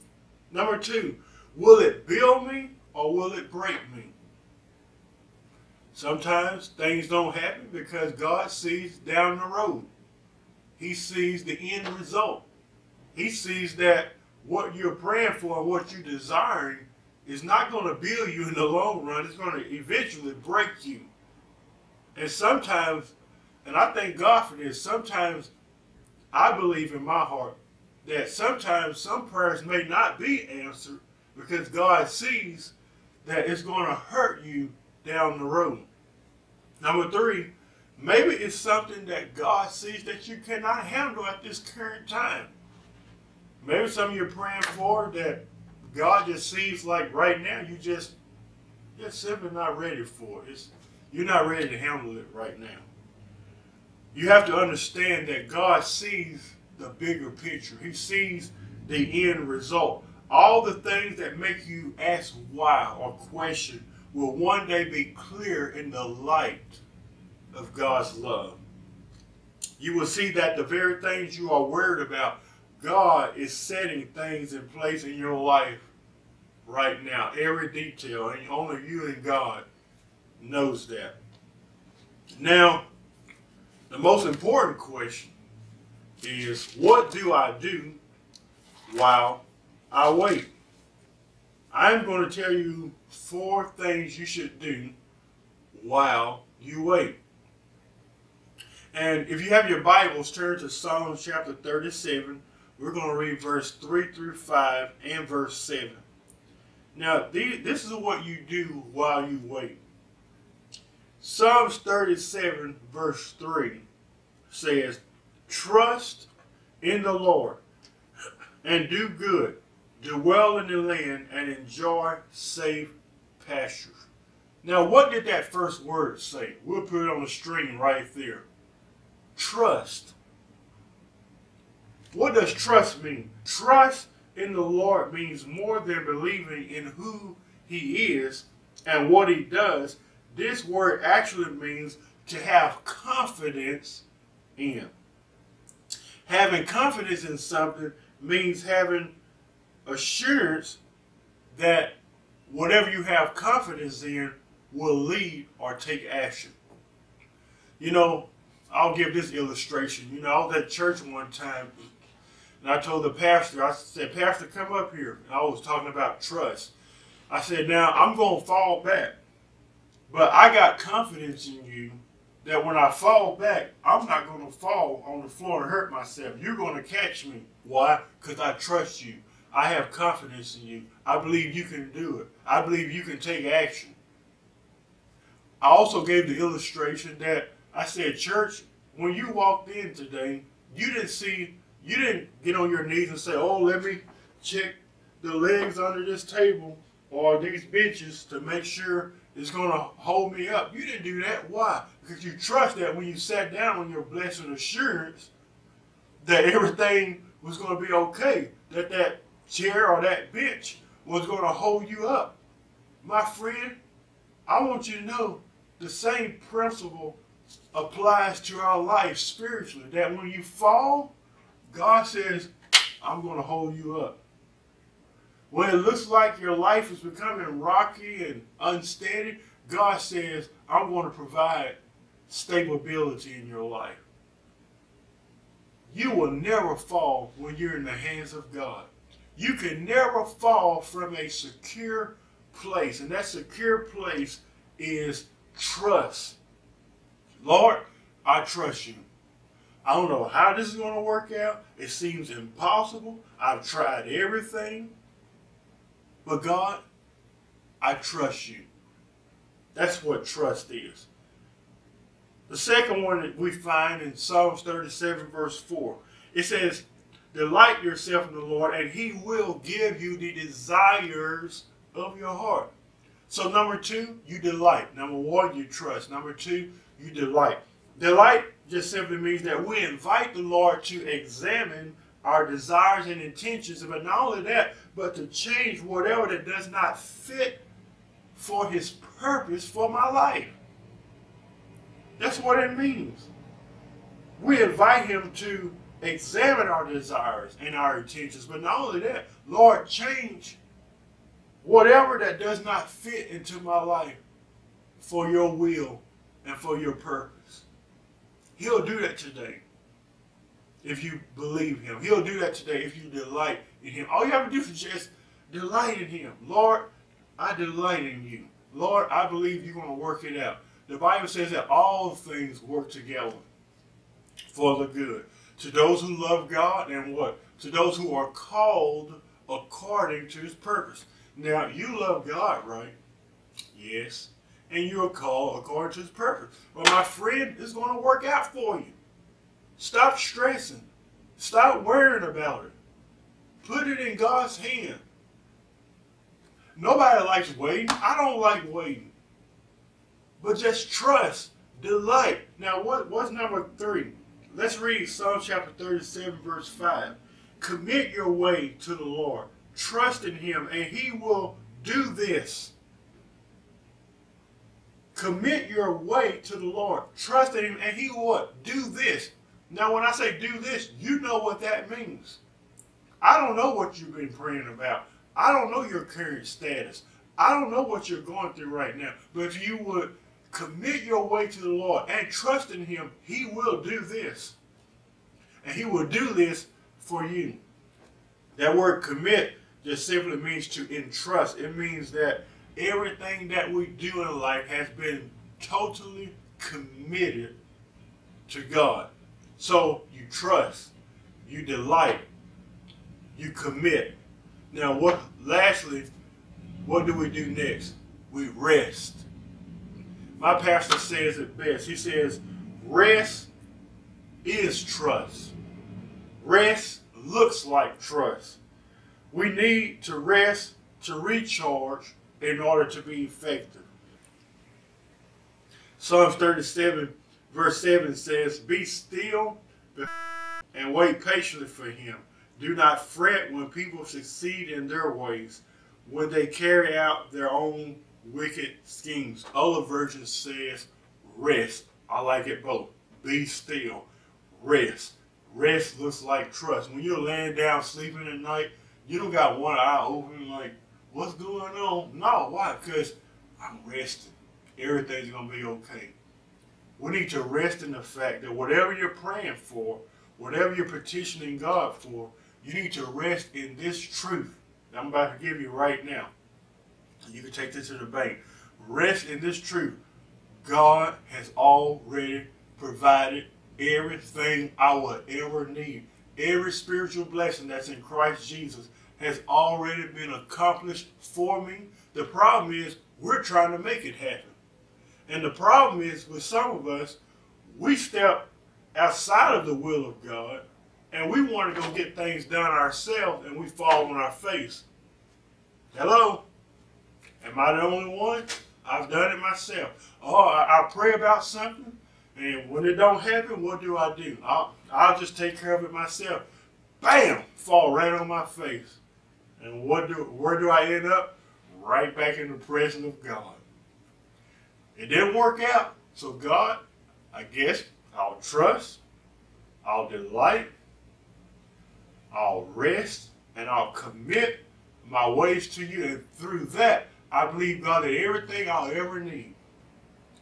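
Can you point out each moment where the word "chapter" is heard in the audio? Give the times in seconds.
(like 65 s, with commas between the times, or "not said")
101 s, 355 s.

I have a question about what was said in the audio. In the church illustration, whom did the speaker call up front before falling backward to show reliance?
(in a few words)
The pastor.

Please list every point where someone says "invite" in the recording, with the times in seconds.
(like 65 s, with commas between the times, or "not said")
279 s, 294 s.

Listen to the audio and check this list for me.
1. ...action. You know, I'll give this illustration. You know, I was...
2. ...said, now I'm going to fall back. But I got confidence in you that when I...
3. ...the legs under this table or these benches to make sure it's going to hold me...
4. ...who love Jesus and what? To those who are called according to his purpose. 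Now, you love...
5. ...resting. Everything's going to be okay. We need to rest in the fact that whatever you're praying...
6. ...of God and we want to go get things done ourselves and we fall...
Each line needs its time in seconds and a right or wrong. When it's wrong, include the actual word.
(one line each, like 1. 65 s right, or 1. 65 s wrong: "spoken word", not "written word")
1. 156 s right
2. 167 s right
3. 195 s right
4. 326 s wrong: "God", not "Jesus"
5. 453 s right
6. 490 s right.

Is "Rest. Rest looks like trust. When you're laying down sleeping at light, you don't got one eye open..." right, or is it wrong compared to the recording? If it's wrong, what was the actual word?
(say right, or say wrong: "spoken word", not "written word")
wrong: "night", not "light".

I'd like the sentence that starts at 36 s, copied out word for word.
Number three, maybe it's something that God sees that you cannot handle at this current time.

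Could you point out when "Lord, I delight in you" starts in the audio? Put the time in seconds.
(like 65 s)
316 s.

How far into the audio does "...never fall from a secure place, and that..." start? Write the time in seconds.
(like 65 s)
239 s.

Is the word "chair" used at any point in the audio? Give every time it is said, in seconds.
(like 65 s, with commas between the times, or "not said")
209 s.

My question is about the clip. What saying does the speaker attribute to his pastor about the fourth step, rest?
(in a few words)
Rest is trust.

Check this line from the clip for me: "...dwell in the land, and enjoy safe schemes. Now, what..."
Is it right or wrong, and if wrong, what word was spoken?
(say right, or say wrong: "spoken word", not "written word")
wrong: "pastures", not "schemes".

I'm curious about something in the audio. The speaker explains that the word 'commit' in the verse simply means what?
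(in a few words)
To entrust.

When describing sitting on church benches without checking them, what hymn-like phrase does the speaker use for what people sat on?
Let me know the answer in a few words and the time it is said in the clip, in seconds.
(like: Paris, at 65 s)
Blessed assurance, at 204 s.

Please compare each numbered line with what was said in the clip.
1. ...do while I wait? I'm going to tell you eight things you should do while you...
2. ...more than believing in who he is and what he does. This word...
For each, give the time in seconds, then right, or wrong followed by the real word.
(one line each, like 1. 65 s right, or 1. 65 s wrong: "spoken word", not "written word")
1. 87 s wrong: "four", not "eight"
2. 135 s right.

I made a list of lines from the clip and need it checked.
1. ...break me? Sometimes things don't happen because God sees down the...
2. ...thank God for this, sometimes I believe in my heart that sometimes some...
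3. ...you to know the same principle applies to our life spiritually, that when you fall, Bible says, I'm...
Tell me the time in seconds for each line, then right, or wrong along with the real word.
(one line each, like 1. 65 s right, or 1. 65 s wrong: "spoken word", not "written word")
1. 3 s right
2. 23 s right
3. 214 s wrong: "God", not "Bible".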